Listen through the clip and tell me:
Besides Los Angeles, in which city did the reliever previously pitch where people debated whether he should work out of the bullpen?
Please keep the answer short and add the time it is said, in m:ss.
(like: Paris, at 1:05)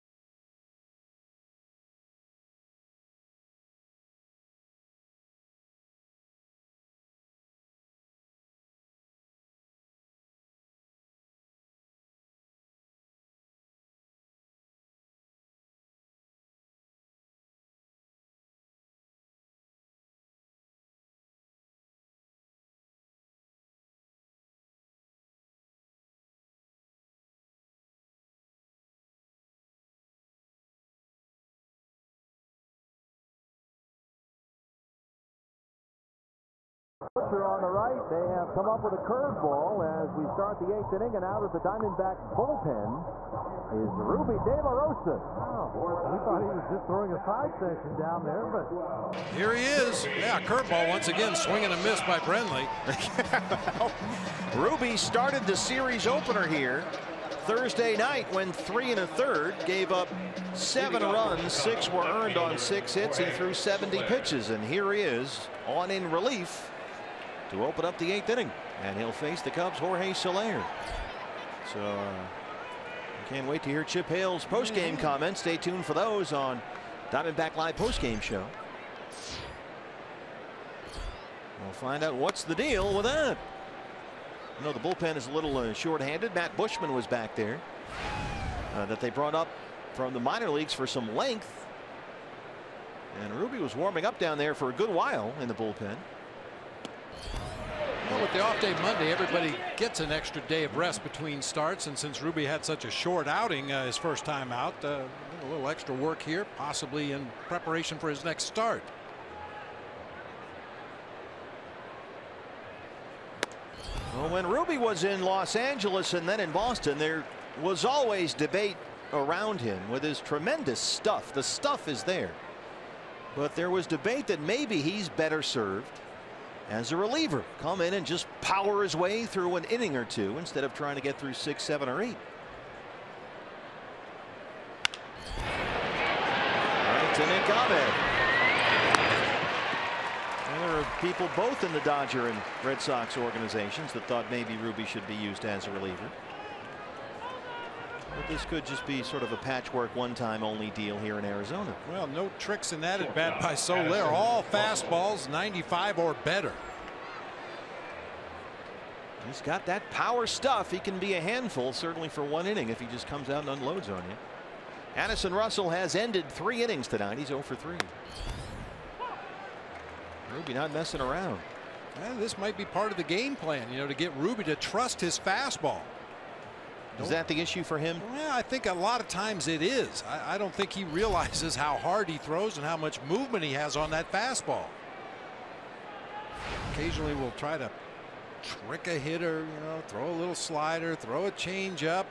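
Boston, at 1:56.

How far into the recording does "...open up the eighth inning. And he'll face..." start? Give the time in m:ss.
1:07.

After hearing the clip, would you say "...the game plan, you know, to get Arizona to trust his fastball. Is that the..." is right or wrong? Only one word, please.
wrong.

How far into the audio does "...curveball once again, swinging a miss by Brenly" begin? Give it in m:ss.
0:50.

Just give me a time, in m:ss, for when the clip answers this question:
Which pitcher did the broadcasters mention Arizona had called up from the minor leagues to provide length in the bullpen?
1:26.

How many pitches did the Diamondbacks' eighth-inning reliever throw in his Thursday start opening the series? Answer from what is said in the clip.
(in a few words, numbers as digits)
70.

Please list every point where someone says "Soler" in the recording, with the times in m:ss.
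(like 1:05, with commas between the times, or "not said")
1:10, 2:33.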